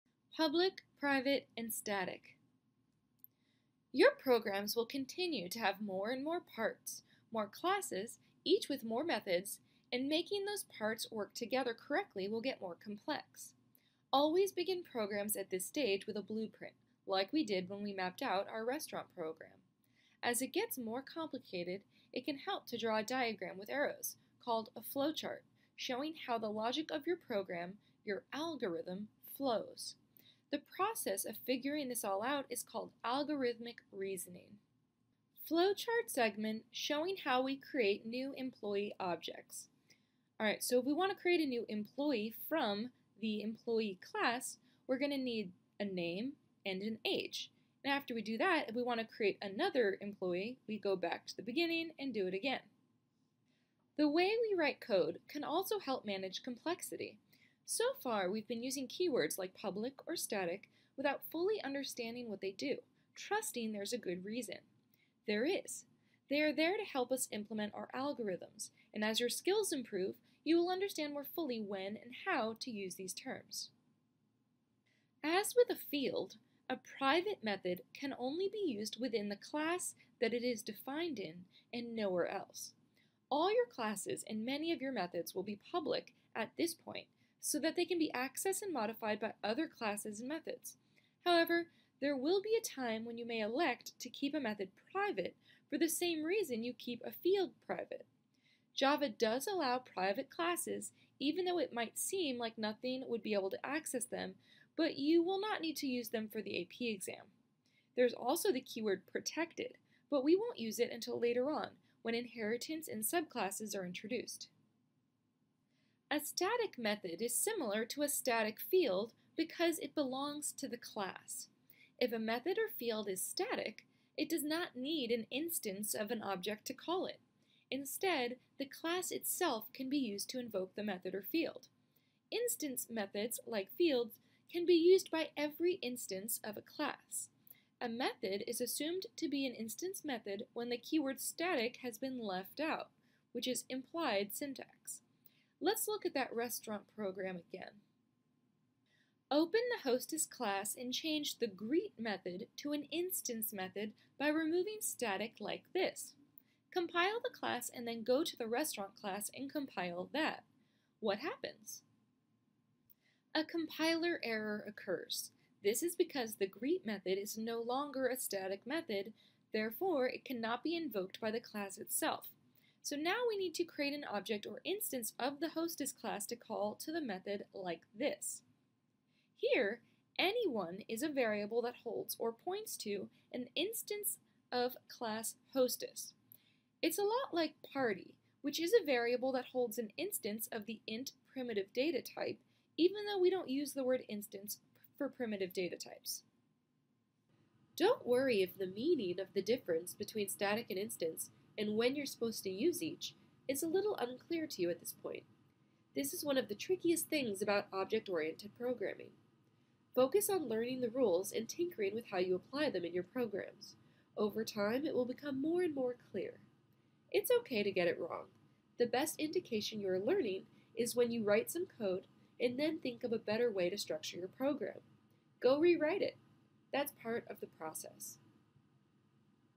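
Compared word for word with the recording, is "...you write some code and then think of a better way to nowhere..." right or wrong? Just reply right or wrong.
wrong.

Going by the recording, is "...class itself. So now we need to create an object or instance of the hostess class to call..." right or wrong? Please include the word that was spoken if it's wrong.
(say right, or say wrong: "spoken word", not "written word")
right.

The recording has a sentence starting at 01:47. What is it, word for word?
There's also the keyword protected, but we won't use it until later on, when inheritance and subclasses are introduced.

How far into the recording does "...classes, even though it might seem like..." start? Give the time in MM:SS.
01:40.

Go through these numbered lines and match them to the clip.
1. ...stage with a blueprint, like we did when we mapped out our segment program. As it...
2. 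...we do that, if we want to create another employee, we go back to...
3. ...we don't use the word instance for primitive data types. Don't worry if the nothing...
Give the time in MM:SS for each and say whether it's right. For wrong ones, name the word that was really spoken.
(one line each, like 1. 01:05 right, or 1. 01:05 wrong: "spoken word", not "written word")
1. 00:15 wrong: "restaurant", not "segment"
2. 00:48 right
3. 03:13 wrong: "meaning", not "nothing".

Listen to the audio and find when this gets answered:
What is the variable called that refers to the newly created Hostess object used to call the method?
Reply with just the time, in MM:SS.
03:00.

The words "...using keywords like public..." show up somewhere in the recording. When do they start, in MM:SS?
00:58.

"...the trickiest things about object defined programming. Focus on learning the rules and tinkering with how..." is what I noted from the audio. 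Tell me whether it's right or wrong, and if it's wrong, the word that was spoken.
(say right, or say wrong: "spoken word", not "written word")
wrong: "oriented", not "defined".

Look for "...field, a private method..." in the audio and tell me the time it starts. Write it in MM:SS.
01:15.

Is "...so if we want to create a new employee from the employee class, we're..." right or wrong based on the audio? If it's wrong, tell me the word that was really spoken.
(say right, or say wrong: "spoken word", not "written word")
right.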